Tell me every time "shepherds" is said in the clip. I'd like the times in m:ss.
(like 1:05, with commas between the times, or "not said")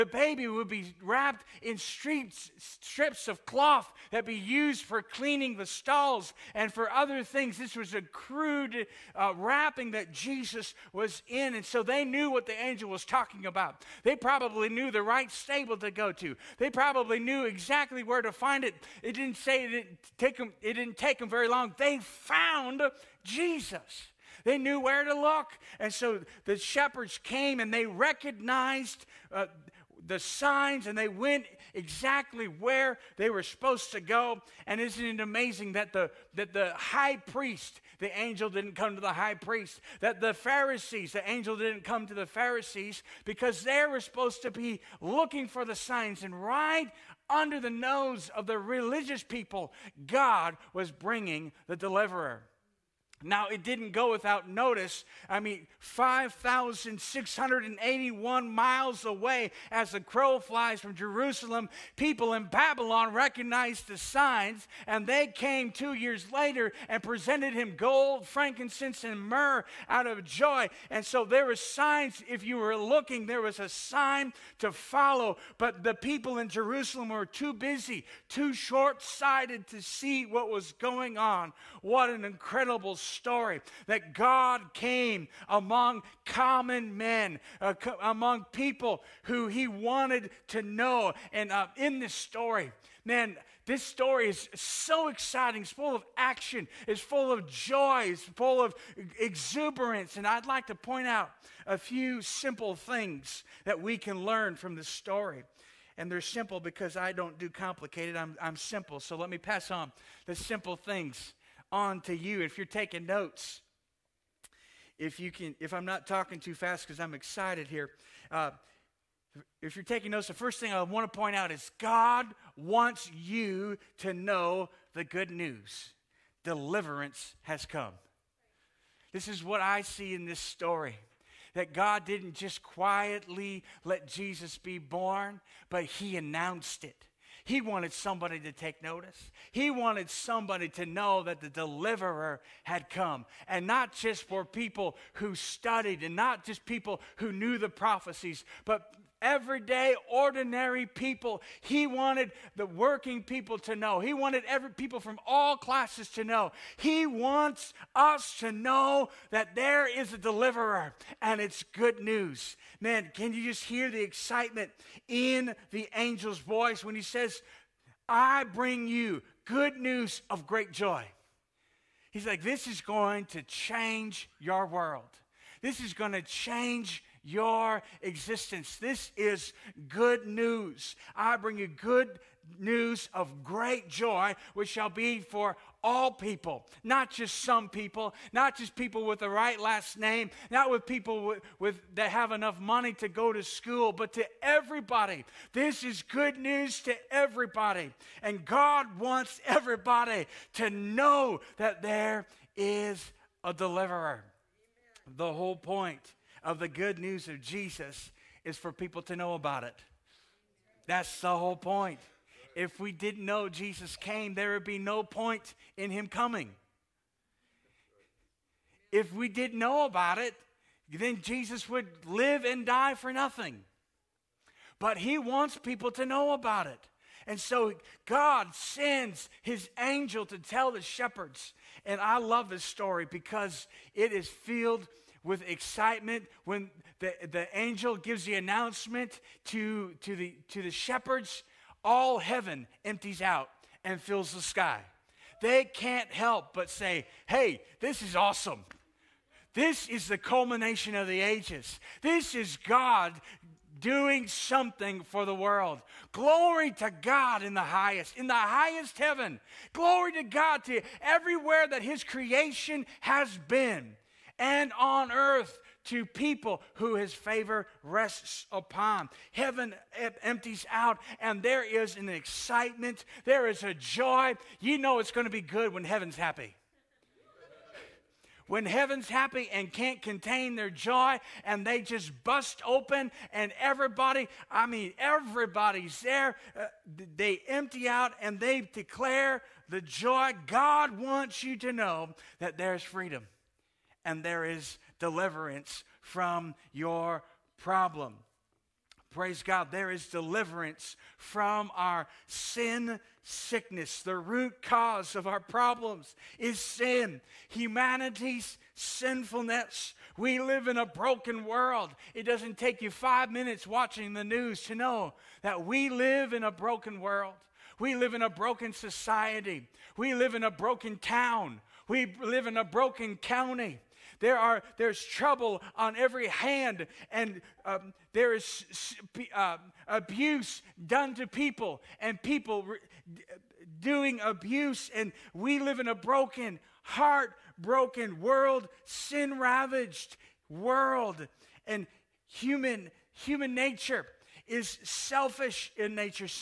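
0:26, 3:50, 4:00.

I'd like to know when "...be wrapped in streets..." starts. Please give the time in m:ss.
0:00.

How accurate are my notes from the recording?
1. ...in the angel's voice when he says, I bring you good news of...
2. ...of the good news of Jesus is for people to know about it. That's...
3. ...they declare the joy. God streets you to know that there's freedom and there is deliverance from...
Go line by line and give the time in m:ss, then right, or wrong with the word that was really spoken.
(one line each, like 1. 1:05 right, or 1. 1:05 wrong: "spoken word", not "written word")
1. 2:45 right
2. 3:26 right
3. 4:48 wrong: "wants", not "streets".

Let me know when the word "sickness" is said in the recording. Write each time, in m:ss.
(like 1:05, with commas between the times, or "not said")
5:03.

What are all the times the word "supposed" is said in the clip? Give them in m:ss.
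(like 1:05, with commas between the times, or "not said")
0:33, 0:43.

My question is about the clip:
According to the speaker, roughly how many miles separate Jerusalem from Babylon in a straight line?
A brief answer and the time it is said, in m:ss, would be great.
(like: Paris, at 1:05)
5,681 miles, at 0:55.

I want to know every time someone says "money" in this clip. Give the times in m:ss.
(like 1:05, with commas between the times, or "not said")
3:12.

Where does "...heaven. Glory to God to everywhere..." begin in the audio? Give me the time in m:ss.
4:18.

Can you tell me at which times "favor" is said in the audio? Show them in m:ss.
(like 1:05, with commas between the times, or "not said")
4:27.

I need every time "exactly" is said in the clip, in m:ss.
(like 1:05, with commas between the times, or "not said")
0:17, 0:31.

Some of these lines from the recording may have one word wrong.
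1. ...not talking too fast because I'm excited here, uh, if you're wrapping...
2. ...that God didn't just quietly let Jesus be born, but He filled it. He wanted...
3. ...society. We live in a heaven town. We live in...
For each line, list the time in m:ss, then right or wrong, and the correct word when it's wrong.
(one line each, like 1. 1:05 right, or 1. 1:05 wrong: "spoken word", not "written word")
1. 1:55 wrong: "taking", not "wrapping"
2. 2:11 wrong: "announced", not "filled"
3. 5:18 wrong: "broken", not "heaven".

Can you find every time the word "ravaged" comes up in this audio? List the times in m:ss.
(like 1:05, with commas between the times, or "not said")
5:39.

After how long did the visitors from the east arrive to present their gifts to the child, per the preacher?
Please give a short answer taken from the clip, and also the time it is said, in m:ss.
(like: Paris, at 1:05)
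two years later, at 1:05.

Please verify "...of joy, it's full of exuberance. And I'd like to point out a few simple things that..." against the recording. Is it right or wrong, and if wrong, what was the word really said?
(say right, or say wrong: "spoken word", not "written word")
right.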